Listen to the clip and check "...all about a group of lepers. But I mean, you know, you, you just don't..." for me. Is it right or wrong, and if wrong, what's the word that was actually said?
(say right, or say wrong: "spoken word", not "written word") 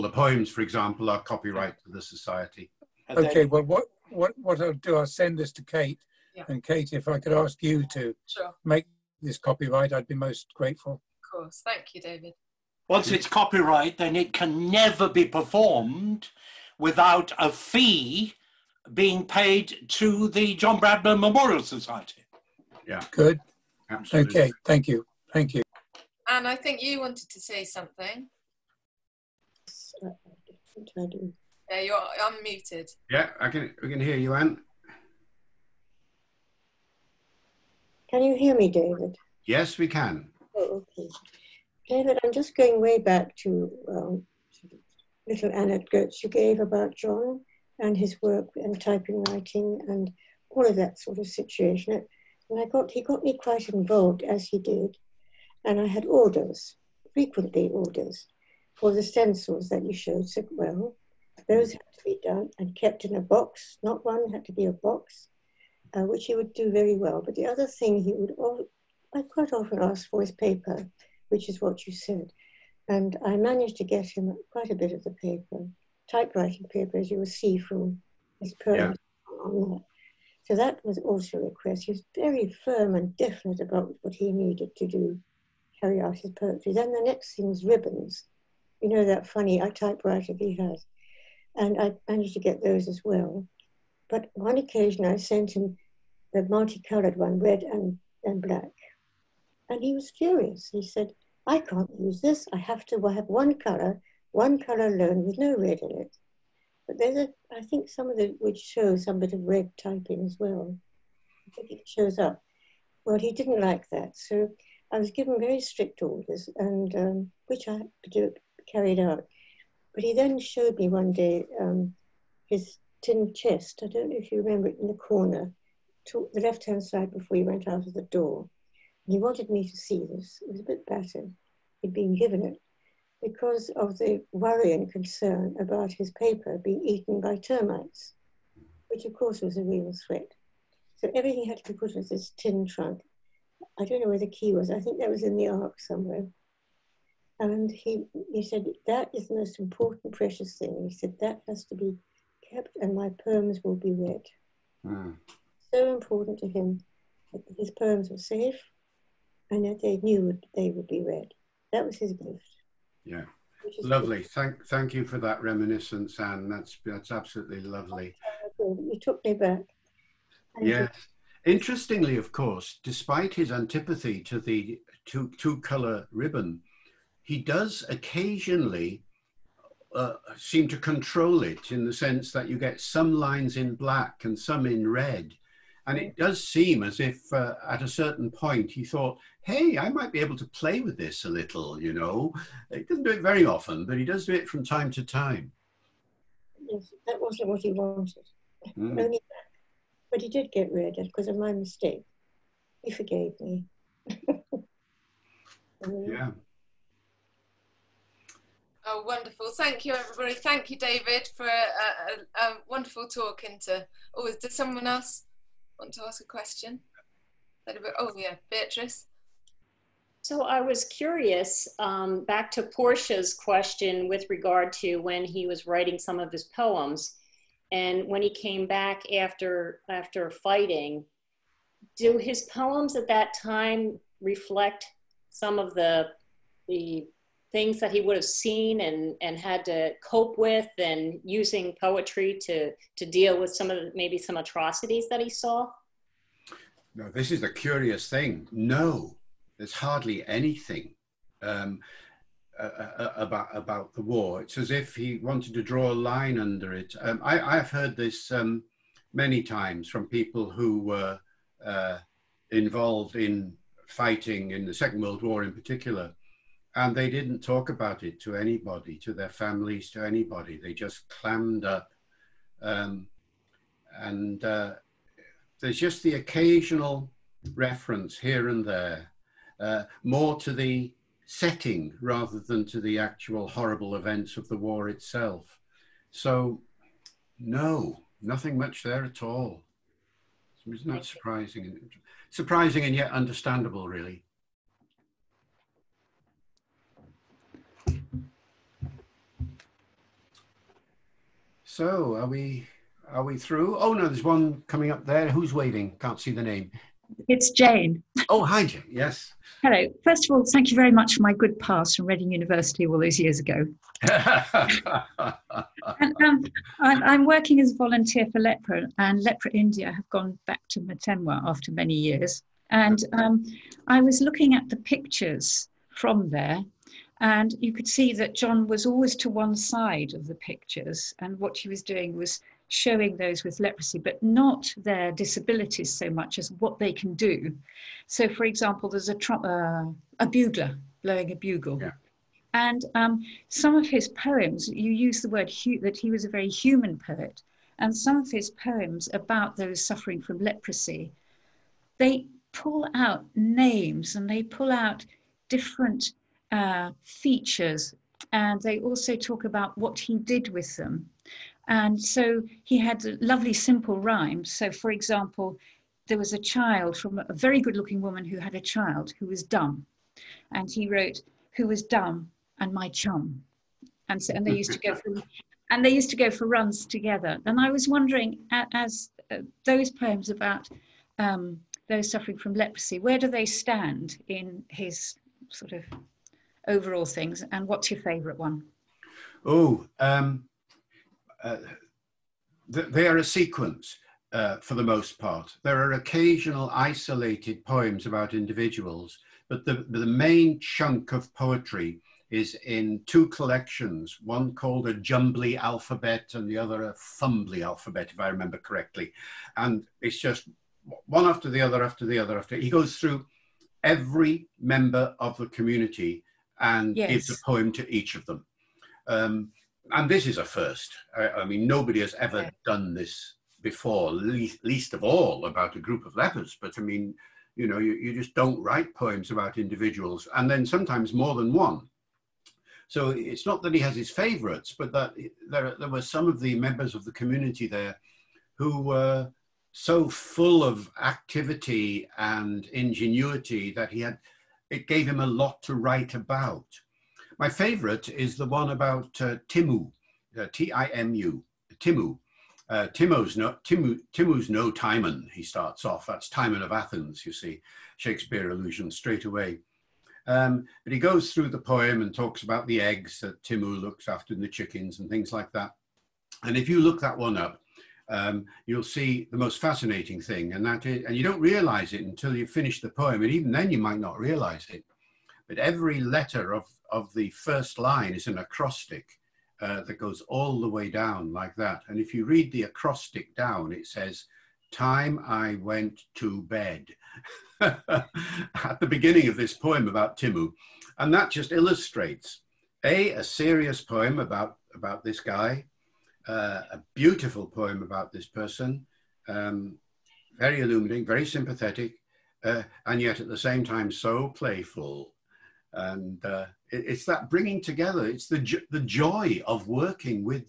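right.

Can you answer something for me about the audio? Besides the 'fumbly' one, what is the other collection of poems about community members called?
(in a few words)
A Jumbly Alphabet.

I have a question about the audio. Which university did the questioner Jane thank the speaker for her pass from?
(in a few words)
Reading University.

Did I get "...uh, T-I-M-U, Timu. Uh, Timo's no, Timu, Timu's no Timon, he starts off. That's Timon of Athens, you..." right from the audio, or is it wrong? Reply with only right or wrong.
right.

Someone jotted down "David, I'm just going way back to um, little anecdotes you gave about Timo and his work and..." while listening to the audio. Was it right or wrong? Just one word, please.
wrong.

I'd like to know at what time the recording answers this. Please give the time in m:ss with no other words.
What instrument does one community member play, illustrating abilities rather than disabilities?
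5:41.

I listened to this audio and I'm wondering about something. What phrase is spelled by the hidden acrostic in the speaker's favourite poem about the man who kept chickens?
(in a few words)
Time I went to bed.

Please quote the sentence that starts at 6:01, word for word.
And so he had lovely simple rhymes.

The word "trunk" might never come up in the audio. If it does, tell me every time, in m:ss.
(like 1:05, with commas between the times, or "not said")
2:22.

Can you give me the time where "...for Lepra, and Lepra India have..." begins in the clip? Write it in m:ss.
5:18.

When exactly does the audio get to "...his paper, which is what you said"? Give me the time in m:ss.
1:10.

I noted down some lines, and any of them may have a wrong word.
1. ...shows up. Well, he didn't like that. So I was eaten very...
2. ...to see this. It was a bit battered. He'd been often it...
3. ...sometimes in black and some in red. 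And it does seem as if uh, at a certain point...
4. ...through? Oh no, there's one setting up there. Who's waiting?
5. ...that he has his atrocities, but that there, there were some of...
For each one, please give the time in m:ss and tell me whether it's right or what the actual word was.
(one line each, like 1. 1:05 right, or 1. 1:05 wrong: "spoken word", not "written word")
1. 1:51 wrong: "given", not "eaten"
2. 2:09 wrong: "given", not "often"
3. 3:03 wrong: "lines", not "sometimes"
4. 5:03 wrong: "coming", not "setting"
5. 7:13 wrong: "favorites", not "atrocities".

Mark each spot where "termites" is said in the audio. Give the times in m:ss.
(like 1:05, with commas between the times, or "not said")
2:17.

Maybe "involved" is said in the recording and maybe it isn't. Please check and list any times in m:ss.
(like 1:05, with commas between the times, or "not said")
0:53, 4:22.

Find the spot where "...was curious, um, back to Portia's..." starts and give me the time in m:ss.
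3:40.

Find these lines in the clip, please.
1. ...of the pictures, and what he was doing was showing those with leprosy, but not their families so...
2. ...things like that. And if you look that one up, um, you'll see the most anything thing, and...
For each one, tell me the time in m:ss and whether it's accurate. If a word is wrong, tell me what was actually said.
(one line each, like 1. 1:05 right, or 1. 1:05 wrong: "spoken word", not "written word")
1. 5:30 wrong: "disabilities", not "families"
2. 7:45 wrong: "fascinating", not "anything".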